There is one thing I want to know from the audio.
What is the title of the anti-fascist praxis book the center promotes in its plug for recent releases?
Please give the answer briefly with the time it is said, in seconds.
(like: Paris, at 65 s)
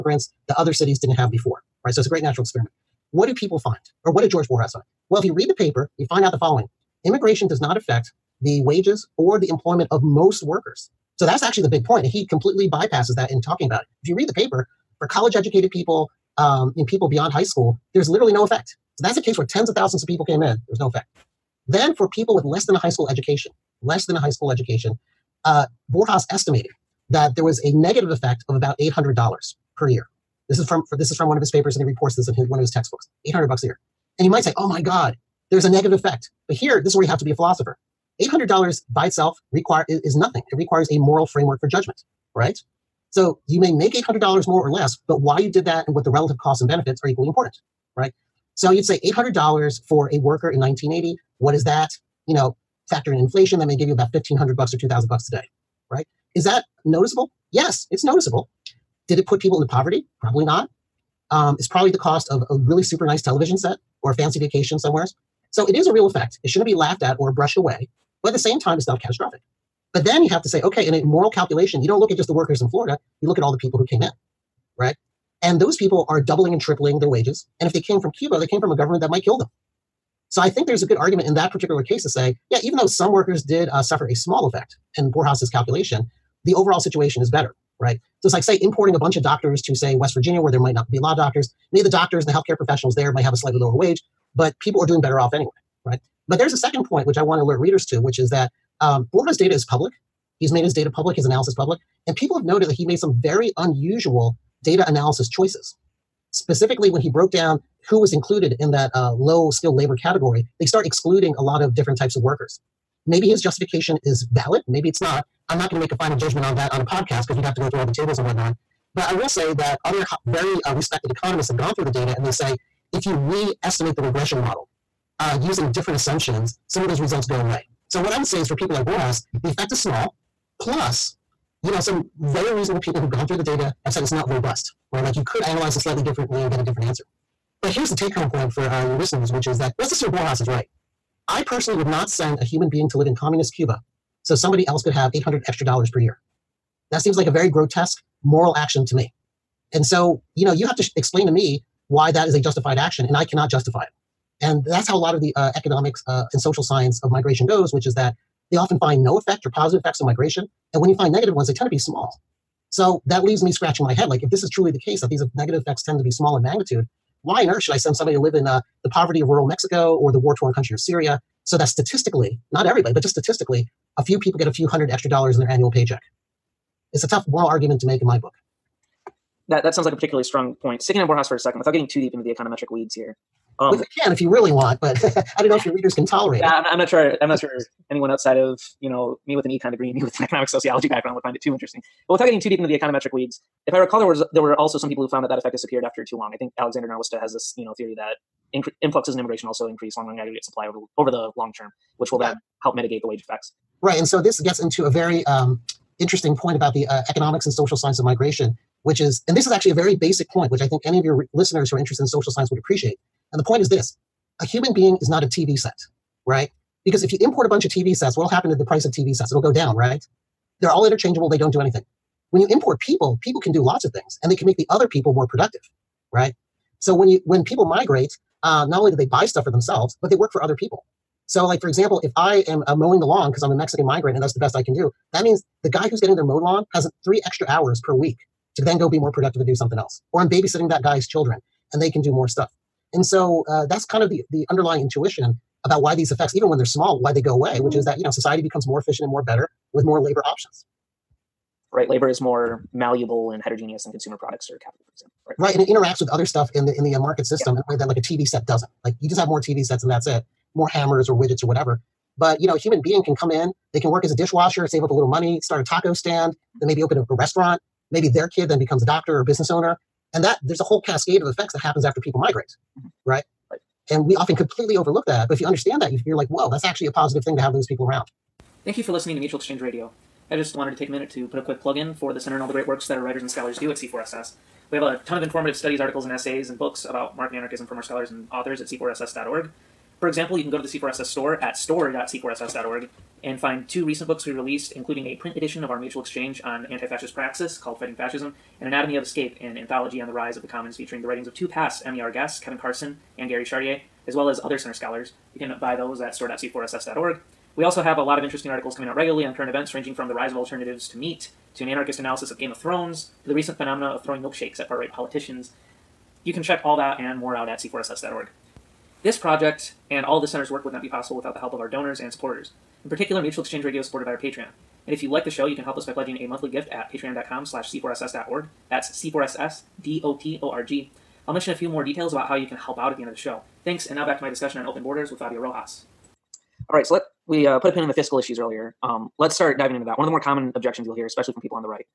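Fighting Fascism, at 297 s.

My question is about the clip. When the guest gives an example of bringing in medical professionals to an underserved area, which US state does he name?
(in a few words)
West Virginia.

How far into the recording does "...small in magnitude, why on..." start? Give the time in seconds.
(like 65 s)
166 s.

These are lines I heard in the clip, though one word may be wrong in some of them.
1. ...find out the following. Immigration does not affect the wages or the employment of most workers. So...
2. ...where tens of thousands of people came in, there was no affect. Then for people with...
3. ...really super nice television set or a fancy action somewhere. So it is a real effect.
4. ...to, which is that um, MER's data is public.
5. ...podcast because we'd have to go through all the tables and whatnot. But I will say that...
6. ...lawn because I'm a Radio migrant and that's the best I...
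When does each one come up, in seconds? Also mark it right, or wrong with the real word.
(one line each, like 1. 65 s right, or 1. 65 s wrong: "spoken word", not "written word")
1. 6 s right
2. 19 s wrong: "effect", not "affect"
3. 62 s wrong: "vacation", not "action"
4. 97 s wrong: "Borjas", not "MER"
5. 116 s right
6. 233 s wrong: "Mexican", not "Radio".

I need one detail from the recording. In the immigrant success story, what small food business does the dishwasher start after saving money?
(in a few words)
A taco stand.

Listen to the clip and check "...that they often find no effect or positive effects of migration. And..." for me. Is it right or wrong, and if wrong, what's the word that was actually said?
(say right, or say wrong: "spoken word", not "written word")
right.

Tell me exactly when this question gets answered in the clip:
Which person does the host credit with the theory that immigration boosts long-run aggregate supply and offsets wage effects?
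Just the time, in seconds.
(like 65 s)
196 s.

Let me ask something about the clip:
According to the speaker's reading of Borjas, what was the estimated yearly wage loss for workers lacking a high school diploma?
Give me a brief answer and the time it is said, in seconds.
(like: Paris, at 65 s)
$800, at 28 s.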